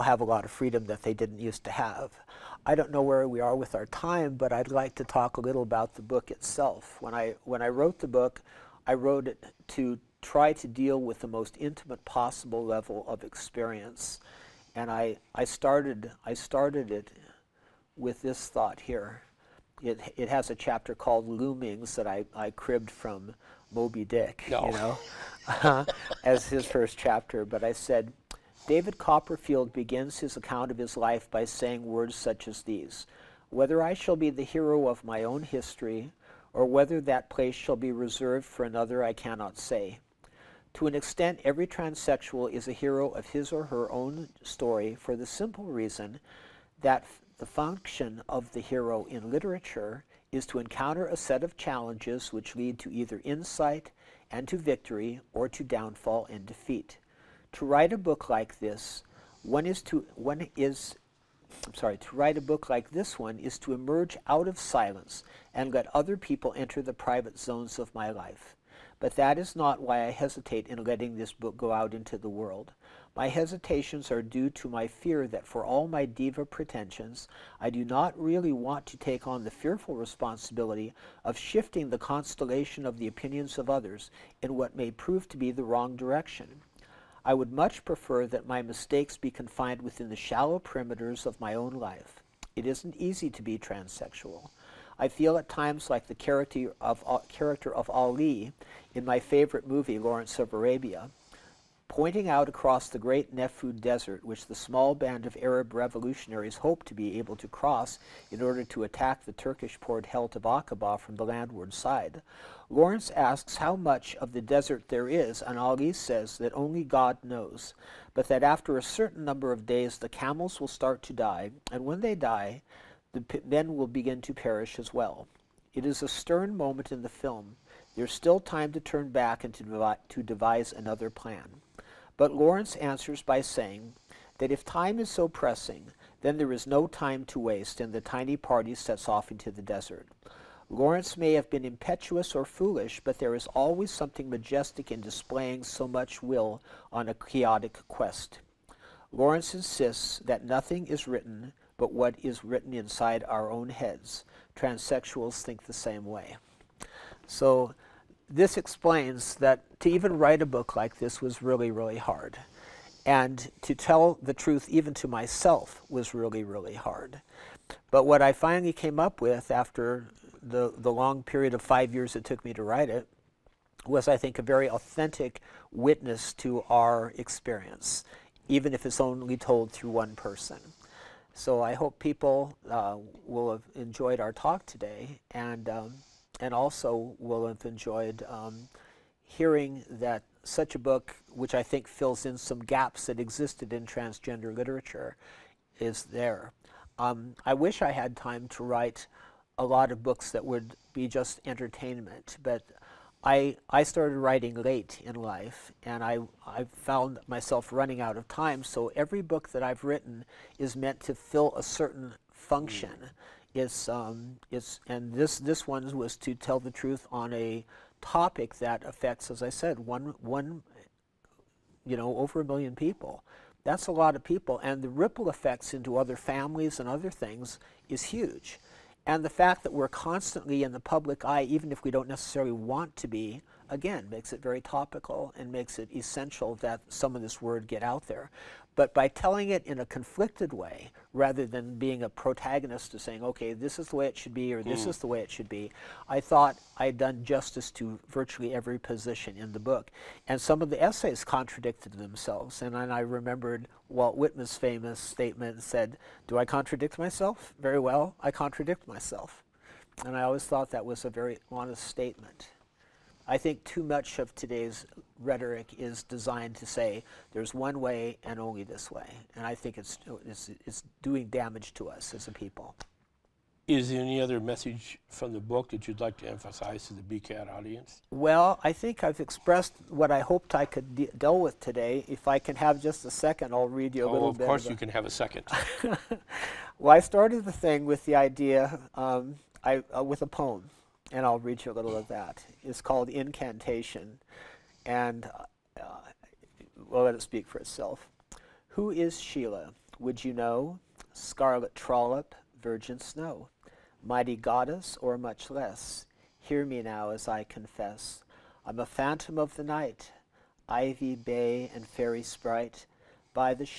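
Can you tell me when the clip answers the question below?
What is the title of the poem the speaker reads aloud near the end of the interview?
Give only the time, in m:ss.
4:53.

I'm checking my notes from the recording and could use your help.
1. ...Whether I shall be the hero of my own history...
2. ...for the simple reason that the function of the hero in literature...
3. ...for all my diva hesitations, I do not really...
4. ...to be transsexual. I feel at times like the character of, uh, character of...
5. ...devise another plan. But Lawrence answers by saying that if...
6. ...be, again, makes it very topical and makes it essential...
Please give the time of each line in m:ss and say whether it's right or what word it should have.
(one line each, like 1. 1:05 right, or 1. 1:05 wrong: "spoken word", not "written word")
1. 0:33 right
2. 0:44 right
3. 1:15 wrong: "pretensions", not "hesitations"
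4. 1:33 right
5. 2:10 right
6. 3:53 right.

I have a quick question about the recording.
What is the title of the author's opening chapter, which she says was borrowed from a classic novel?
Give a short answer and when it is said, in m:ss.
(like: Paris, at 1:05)
Loomings, at 0:21.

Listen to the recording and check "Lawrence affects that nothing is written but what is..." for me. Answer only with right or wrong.
wrong.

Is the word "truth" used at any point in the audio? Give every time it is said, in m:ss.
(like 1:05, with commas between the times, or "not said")
2:44, 3:36.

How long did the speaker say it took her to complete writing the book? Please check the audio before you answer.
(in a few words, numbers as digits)
5 years.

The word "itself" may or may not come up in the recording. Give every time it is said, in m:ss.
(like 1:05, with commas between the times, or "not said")
0:06, 4:57.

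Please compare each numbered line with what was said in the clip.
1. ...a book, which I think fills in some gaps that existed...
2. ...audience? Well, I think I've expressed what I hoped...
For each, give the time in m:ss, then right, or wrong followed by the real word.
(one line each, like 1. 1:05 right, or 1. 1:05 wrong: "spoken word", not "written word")
1. 3:10 right
2. 4:37 right.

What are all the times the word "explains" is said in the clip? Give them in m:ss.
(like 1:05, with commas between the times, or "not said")
2:38.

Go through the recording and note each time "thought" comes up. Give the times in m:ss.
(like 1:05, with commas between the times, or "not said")
0:18, 4:06, 4:20.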